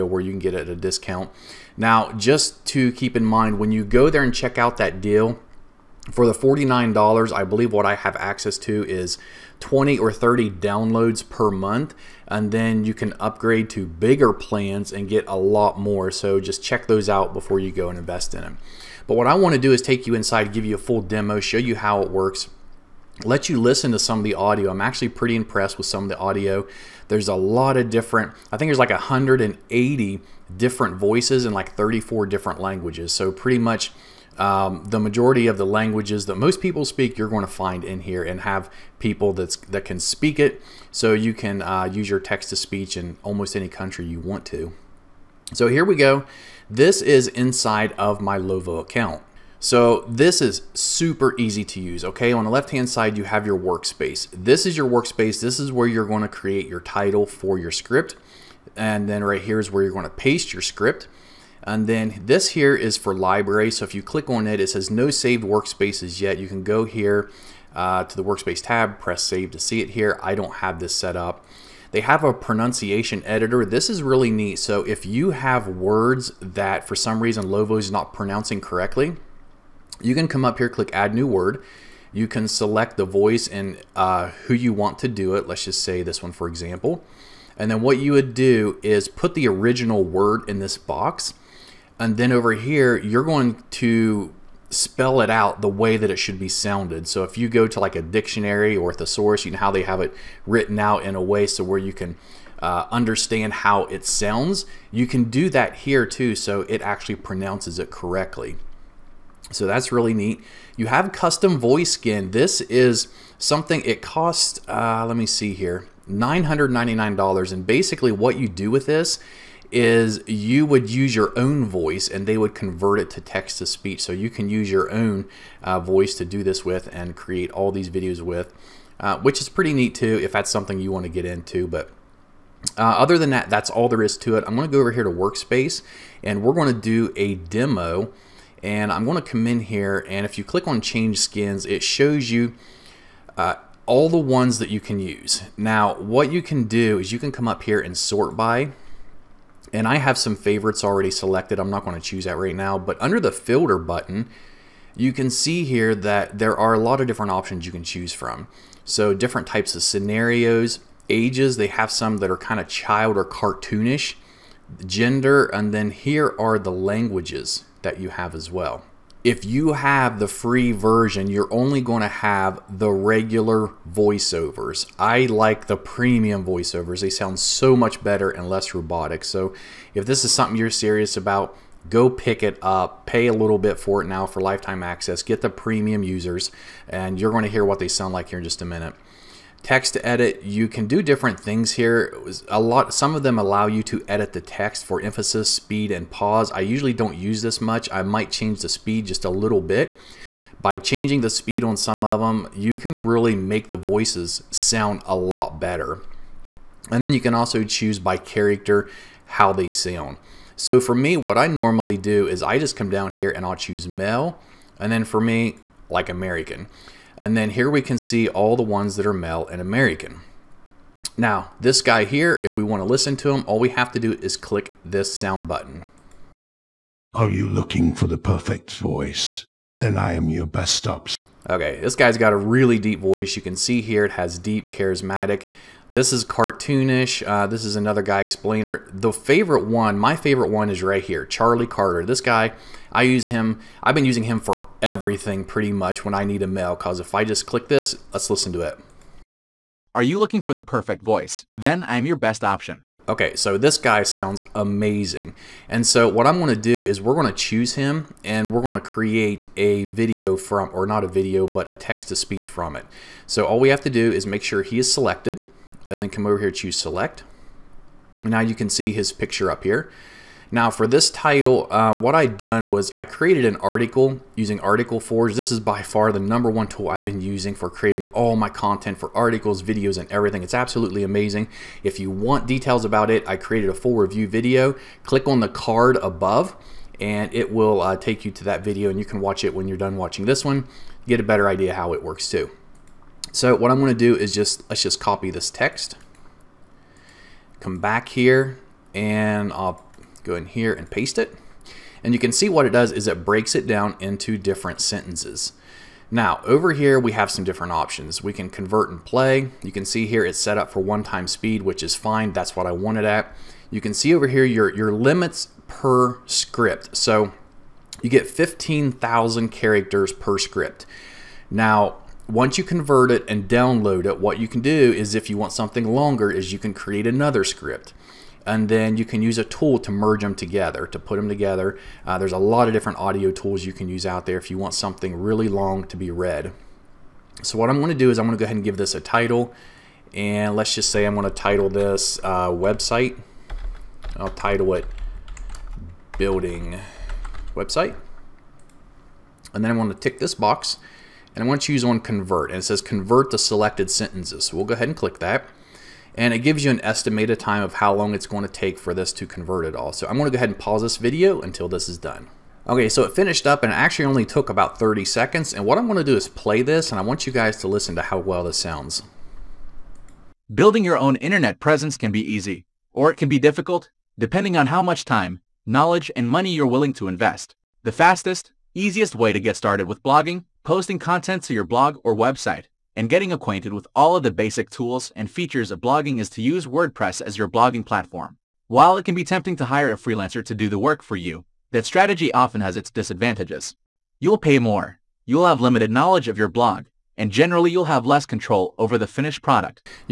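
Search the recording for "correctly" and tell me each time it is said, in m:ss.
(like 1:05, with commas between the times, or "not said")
1:18, 1:47.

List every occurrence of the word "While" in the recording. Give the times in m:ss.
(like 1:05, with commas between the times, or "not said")
6:28.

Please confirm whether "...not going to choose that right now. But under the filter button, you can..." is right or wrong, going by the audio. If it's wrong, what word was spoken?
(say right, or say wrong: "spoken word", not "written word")
right.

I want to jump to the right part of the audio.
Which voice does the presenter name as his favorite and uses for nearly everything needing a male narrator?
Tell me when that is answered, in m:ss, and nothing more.
4:01.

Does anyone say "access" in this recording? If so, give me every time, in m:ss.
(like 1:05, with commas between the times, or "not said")
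0:08, 3:04.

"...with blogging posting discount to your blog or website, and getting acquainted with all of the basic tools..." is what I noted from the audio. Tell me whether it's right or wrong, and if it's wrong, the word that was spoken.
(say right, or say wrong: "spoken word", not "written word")
wrong: "content", not "discount".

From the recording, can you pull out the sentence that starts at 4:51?
Get a better idea how it works too.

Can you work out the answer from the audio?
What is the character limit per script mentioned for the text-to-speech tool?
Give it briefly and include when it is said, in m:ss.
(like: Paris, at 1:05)
15,000, at 5:18.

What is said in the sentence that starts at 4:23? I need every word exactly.
So all we have to do is make sure he is selected and then come over here, choose select.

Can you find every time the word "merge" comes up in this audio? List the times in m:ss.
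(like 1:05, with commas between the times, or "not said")
5:29.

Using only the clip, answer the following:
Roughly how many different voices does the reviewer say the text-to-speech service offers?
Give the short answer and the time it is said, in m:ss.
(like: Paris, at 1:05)
180, at 0:28.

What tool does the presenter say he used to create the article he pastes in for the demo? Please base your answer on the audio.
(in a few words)
Article Forge.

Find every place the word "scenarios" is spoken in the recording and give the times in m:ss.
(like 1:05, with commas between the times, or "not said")
2:39.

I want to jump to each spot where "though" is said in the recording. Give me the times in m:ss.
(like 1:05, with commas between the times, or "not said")
not said.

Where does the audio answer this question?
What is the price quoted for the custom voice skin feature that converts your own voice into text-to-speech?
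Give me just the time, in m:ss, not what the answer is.
1:56.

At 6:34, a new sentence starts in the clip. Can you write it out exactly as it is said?
You'll pay more, you'll have limited knowledge of your blog, and generally you'll have less control over the finished product.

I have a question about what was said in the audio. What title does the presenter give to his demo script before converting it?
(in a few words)
building website.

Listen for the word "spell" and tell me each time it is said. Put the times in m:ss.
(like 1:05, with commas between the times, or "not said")
1:34.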